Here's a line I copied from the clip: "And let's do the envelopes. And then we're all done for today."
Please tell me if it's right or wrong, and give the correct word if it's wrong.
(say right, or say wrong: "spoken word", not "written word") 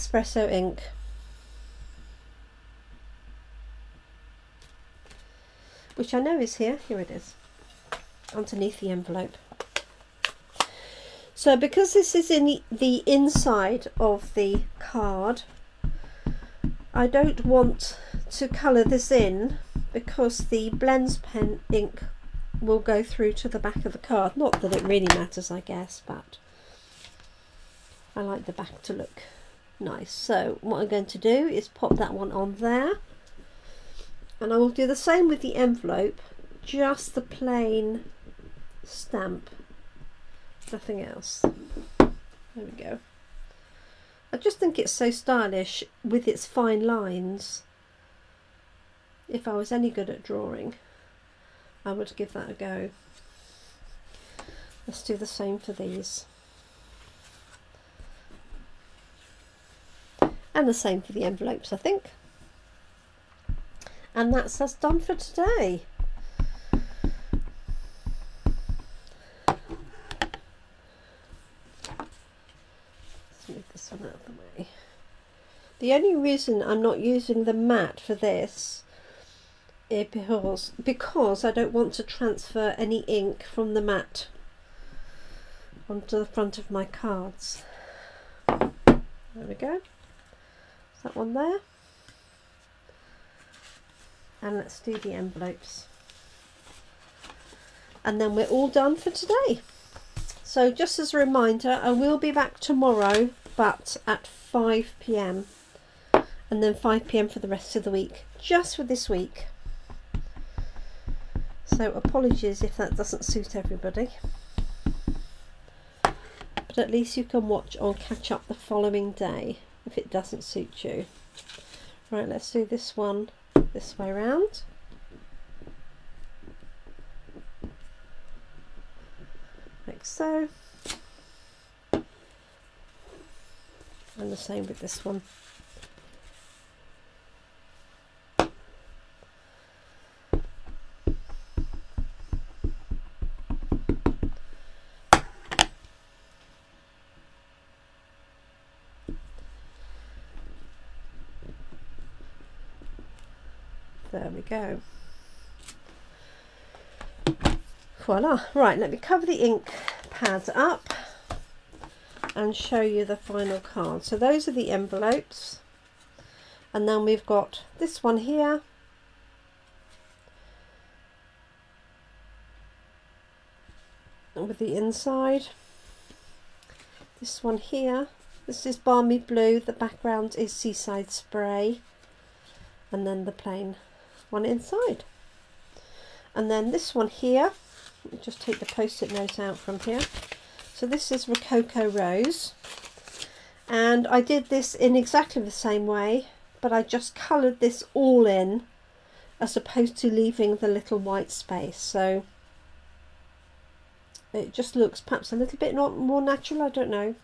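right.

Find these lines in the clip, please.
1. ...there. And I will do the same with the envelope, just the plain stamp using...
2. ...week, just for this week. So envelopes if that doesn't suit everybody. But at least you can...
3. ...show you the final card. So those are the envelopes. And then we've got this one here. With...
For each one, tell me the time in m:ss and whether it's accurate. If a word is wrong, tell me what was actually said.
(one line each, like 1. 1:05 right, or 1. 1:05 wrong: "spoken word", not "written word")
1. 0:32 wrong: "nothing", not "using"
2. 1:47 wrong: "apologies", not "envelopes"
3. 2:42 right.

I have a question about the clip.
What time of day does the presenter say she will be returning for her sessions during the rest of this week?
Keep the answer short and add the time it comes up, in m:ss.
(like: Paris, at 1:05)
5 p.m., at 1:44.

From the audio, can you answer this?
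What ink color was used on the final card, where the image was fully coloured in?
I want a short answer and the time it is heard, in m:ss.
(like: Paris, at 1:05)
Rococo Rose, at 3:11.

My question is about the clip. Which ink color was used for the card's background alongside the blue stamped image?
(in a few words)
Seaside Spray.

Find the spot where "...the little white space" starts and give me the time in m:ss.
3:20.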